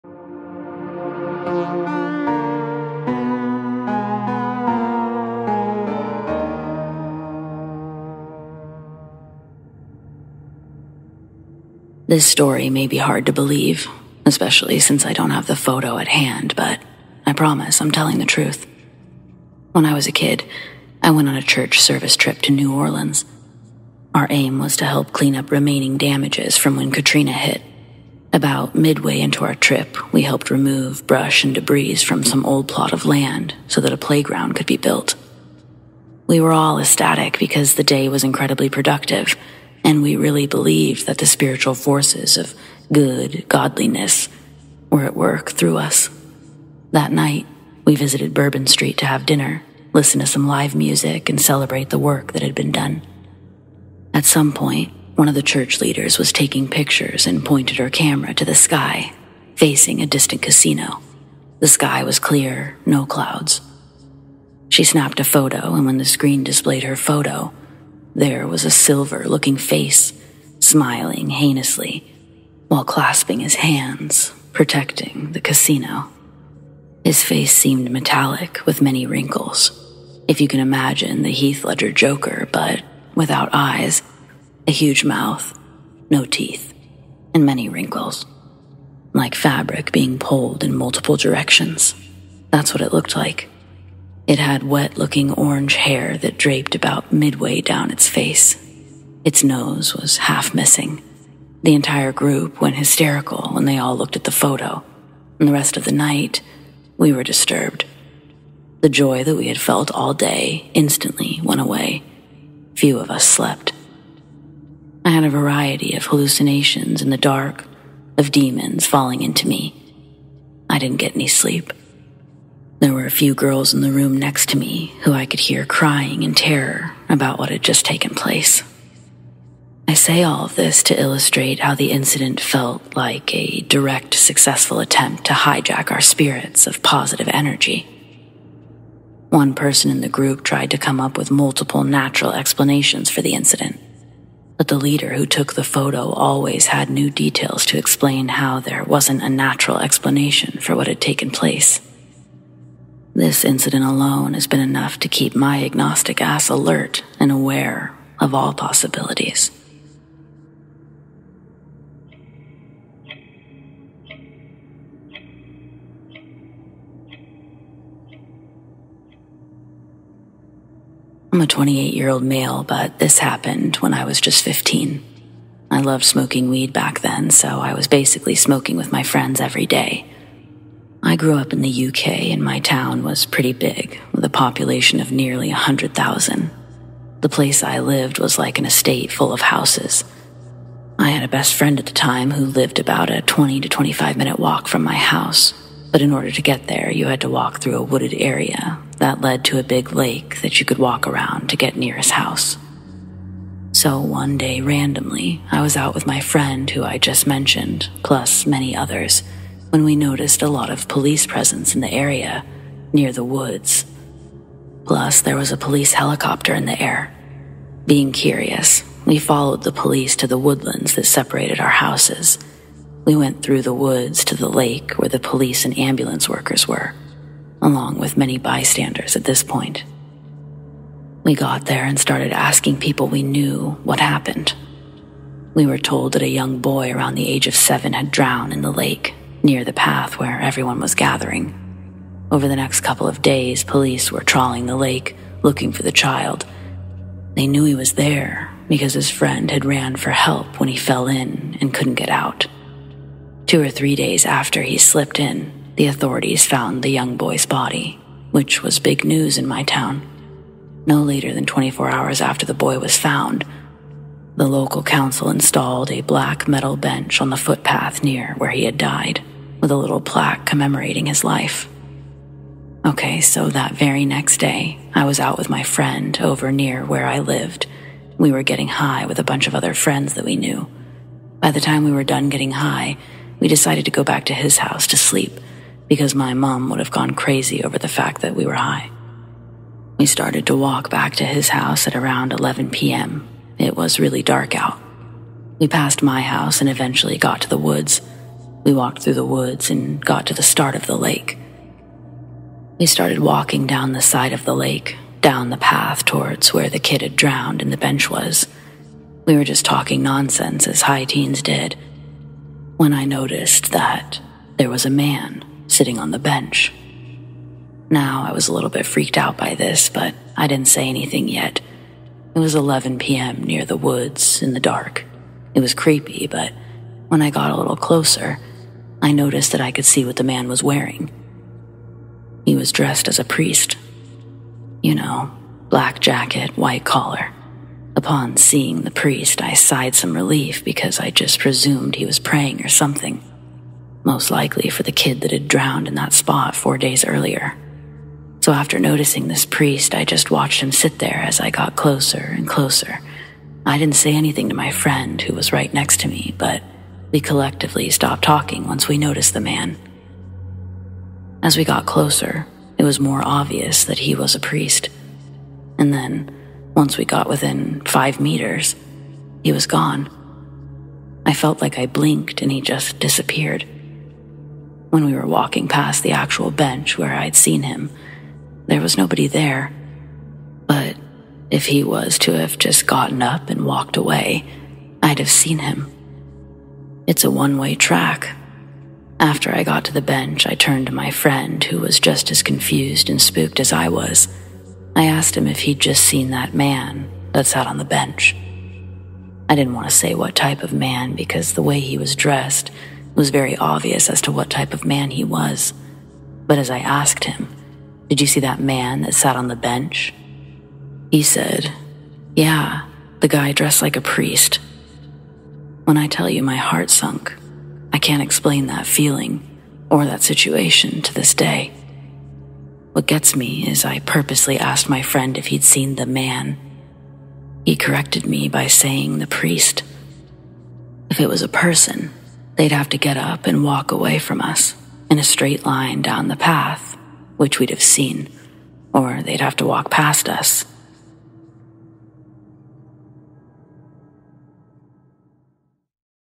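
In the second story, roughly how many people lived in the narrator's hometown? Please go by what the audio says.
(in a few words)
100,000.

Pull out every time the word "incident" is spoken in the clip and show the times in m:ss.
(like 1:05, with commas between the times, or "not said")
2:11, 2:23, 2:33.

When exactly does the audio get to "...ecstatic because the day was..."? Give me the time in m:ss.
0:36.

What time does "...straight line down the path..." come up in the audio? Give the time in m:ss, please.
7:15.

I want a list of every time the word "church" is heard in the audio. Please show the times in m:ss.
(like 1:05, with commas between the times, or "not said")
0:21, 0:55.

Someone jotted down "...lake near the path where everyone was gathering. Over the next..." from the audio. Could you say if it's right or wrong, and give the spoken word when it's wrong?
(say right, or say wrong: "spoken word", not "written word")
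right.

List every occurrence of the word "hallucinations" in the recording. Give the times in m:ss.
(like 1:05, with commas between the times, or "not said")
1:56.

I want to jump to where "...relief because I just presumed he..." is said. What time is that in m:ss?
5:40.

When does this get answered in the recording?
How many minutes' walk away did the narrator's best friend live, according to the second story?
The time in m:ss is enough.
3:13.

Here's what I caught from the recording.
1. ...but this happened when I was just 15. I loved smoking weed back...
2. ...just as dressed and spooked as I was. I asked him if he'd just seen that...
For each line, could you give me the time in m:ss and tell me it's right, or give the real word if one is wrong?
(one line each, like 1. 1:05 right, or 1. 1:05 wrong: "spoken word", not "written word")
1. 2:52 right
2. 6:31 wrong: "confused", not "dressed".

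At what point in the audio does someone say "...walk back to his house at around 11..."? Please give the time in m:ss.
4:50.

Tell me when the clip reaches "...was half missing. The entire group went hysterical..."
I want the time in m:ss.
1:39.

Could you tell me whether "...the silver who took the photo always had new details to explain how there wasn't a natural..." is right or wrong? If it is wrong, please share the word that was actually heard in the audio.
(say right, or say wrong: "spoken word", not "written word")
wrong: "leader", not "silver".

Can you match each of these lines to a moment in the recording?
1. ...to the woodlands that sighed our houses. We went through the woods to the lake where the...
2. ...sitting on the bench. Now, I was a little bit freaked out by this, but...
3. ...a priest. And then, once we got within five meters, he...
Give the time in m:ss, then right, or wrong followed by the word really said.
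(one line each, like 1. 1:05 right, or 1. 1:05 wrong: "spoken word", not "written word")
1. 3:40 wrong: "separated", not "sighed"
2. 5:15 right
3. 6:04 right.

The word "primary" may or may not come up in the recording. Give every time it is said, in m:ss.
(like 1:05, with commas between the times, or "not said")
not said.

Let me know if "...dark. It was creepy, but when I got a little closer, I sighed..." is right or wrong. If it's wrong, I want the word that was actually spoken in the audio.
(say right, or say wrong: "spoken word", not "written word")
wrong: "noticed", not "sighed".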